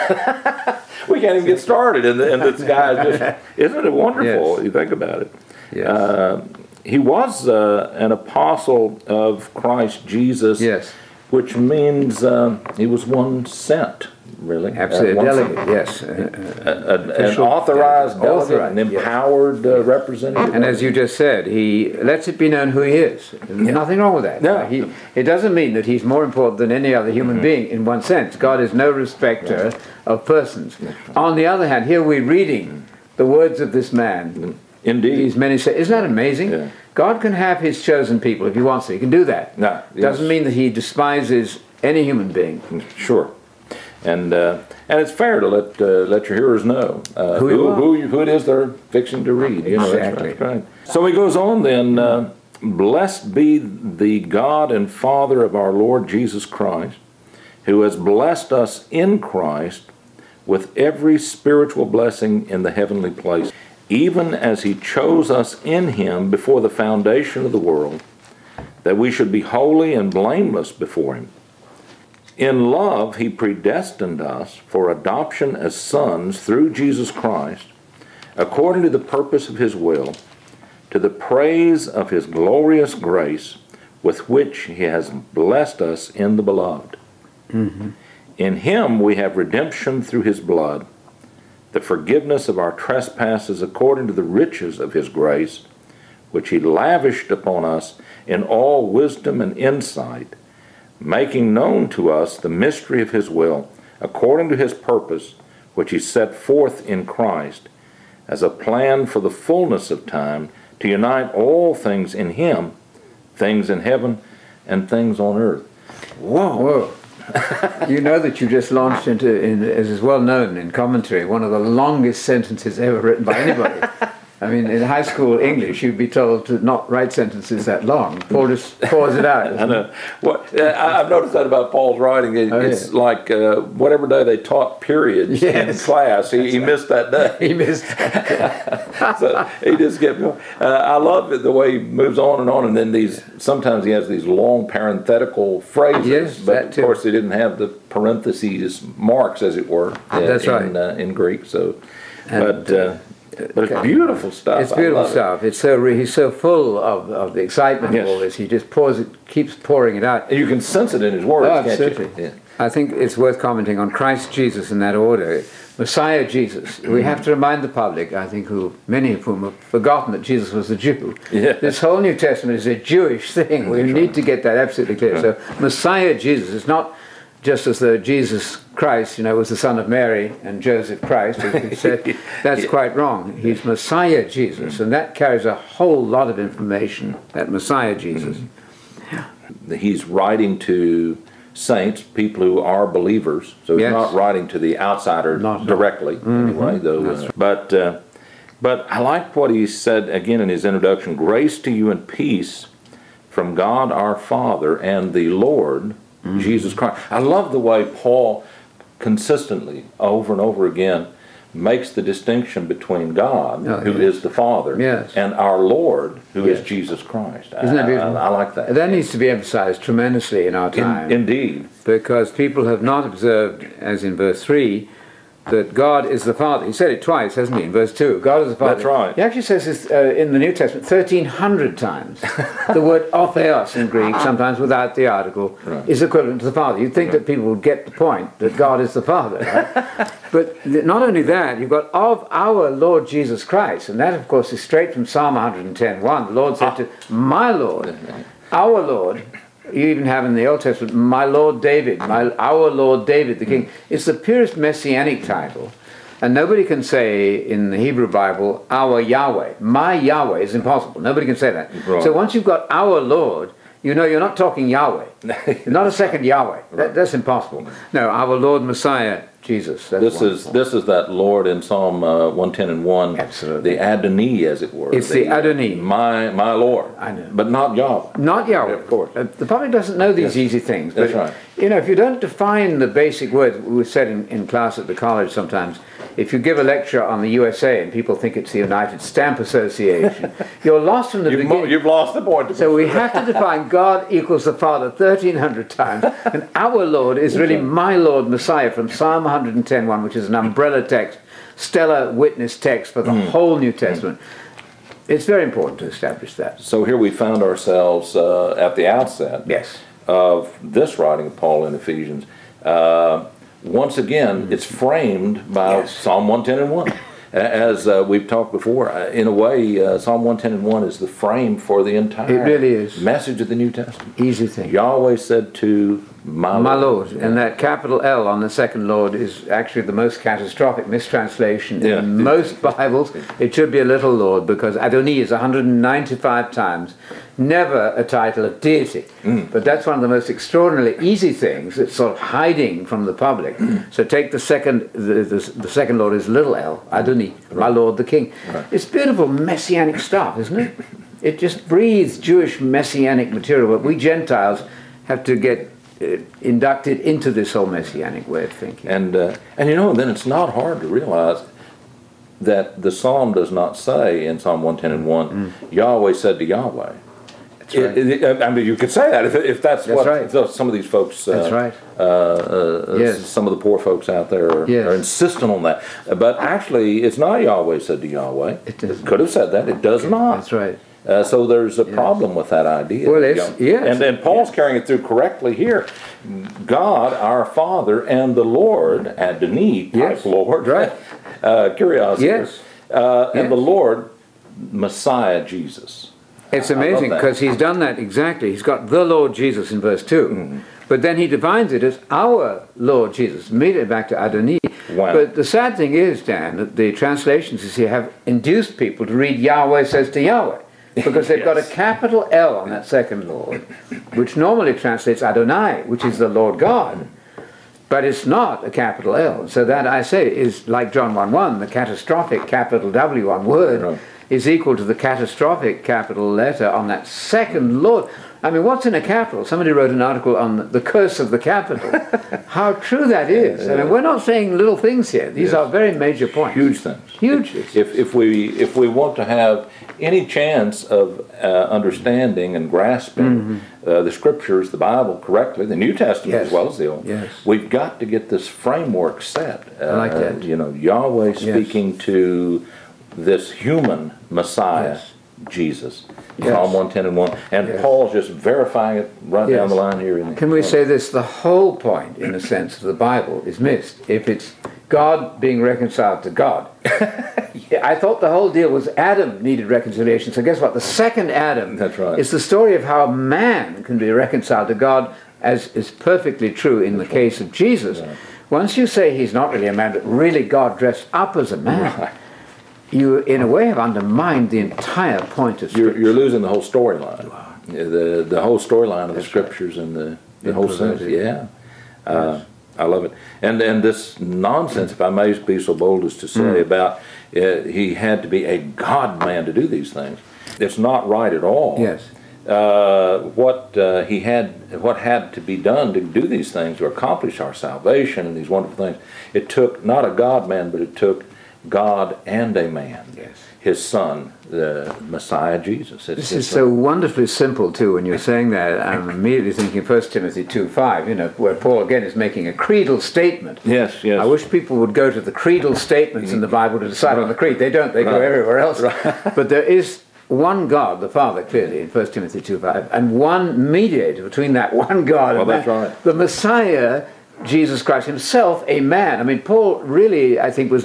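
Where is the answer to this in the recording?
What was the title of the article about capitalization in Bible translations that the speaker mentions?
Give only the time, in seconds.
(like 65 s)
430 s.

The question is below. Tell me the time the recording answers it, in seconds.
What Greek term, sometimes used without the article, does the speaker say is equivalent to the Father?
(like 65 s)
233 s.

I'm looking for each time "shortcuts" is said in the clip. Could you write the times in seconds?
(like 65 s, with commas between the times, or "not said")
not said.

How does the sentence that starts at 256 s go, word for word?
And nobody can say in the Hebrew Bible, our Yahweh, my Yahweh is impossible.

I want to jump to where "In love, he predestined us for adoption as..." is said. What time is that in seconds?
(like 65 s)
72 s.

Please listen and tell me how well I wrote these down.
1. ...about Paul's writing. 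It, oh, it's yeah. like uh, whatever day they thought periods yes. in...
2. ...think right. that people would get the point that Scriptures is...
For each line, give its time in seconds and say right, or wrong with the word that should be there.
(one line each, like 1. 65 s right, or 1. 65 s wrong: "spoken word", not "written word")
1. 131 s wrong: "taught", not "thought"
2. 236 s wrong: "God", not "Scriptures".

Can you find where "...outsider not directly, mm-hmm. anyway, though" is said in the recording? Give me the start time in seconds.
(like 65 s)
194 s.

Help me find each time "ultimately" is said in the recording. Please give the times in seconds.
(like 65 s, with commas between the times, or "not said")
not said.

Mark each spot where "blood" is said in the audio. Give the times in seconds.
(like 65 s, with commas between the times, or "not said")
90 s.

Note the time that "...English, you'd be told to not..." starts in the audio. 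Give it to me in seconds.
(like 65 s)
125 s.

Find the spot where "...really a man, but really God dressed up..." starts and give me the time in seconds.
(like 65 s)
479 s.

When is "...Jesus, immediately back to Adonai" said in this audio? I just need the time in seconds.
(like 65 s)
403 s.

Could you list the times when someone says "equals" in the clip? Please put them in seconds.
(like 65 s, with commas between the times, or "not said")
294 s, 424 s.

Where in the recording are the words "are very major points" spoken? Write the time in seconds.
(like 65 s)
435 s.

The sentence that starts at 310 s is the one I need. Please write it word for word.
of this writing of Paul in Ephesians.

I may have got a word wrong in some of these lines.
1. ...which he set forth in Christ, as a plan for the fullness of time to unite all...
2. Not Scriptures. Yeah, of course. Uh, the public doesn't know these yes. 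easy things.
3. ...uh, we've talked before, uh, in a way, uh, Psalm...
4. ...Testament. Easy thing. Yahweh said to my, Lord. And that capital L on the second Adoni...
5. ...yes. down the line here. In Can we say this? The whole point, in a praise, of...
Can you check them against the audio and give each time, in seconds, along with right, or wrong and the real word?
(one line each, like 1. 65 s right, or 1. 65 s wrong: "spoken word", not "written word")
1. 105 s right
2. 278 s wrong: "Yahweh", not "Scriptures"
3. 317 s right
4. 323 s wrong: "Lord", not "Adoni"
5. 459 s wrong: "sense", not "praise".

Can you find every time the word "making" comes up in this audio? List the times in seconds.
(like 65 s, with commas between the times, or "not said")
100 s, 522 s.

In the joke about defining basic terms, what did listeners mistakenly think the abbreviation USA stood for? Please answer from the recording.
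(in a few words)
United Stamp Association.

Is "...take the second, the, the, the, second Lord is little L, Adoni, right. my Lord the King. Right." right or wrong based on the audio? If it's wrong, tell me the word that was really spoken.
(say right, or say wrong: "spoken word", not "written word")
right.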